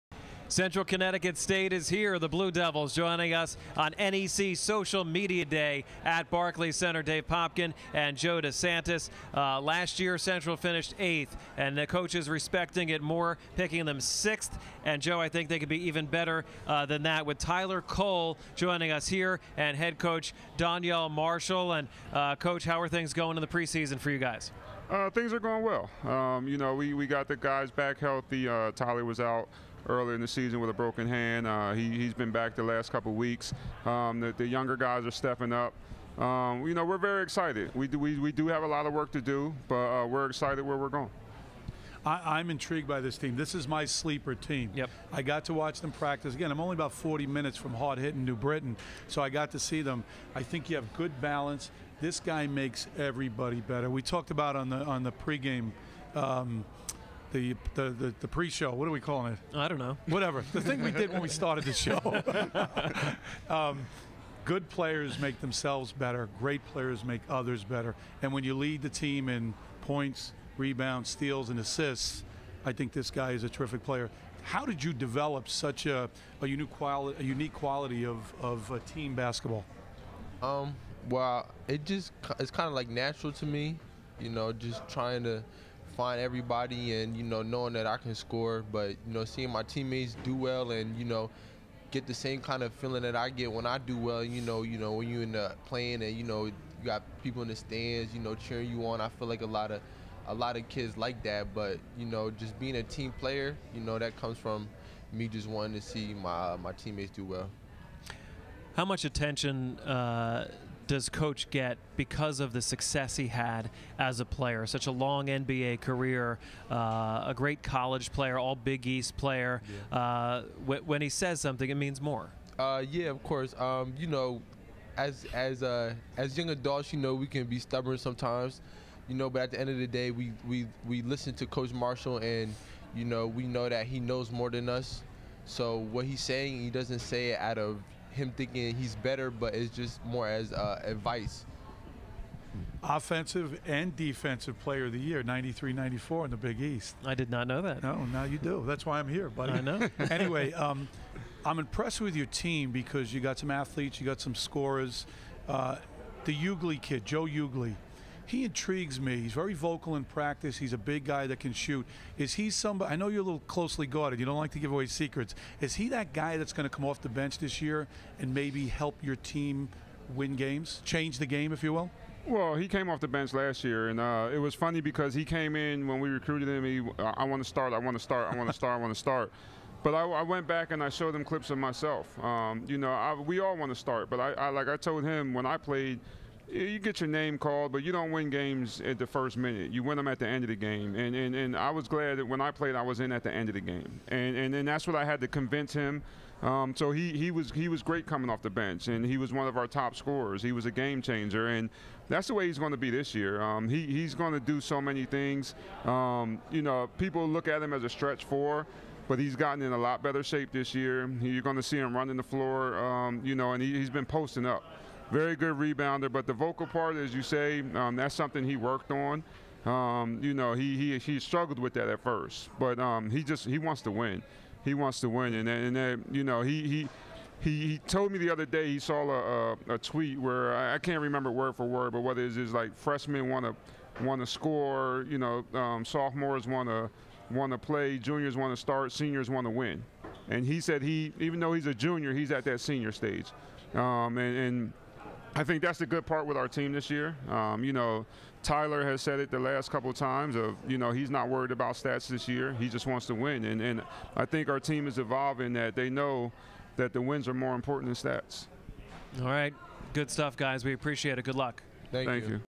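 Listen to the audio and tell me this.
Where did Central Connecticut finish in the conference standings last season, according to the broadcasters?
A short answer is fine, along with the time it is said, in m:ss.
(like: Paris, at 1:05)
Eighth, at 0:10.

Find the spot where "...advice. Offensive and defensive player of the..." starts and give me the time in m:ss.
2:20.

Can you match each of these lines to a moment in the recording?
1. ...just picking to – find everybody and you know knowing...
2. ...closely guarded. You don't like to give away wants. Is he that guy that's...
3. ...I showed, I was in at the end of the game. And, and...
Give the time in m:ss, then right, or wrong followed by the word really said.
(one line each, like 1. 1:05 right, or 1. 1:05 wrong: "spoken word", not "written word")
1. 1:24 wrong: "trying", not "picking"
2. 2:43 wrong: "secrets", not "wants"
3. 3:12 wrong: "played", not "showed".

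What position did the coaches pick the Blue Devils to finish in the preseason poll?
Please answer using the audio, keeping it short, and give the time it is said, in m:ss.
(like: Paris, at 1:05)
Sixth, at 0:14.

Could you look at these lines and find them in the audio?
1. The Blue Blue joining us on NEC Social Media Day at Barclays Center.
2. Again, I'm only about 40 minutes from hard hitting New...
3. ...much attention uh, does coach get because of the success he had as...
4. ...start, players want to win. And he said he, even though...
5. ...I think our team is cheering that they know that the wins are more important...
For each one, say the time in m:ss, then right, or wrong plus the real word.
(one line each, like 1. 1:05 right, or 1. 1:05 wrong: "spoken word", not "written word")
1. 0:02 wrong: "Devils", not "Blue"
2. 0:46 right
3. 1:48 right
4. 3:58 wrong: "seniors", not "players"
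5. 4:14 wrong: "evolving", not "cheering".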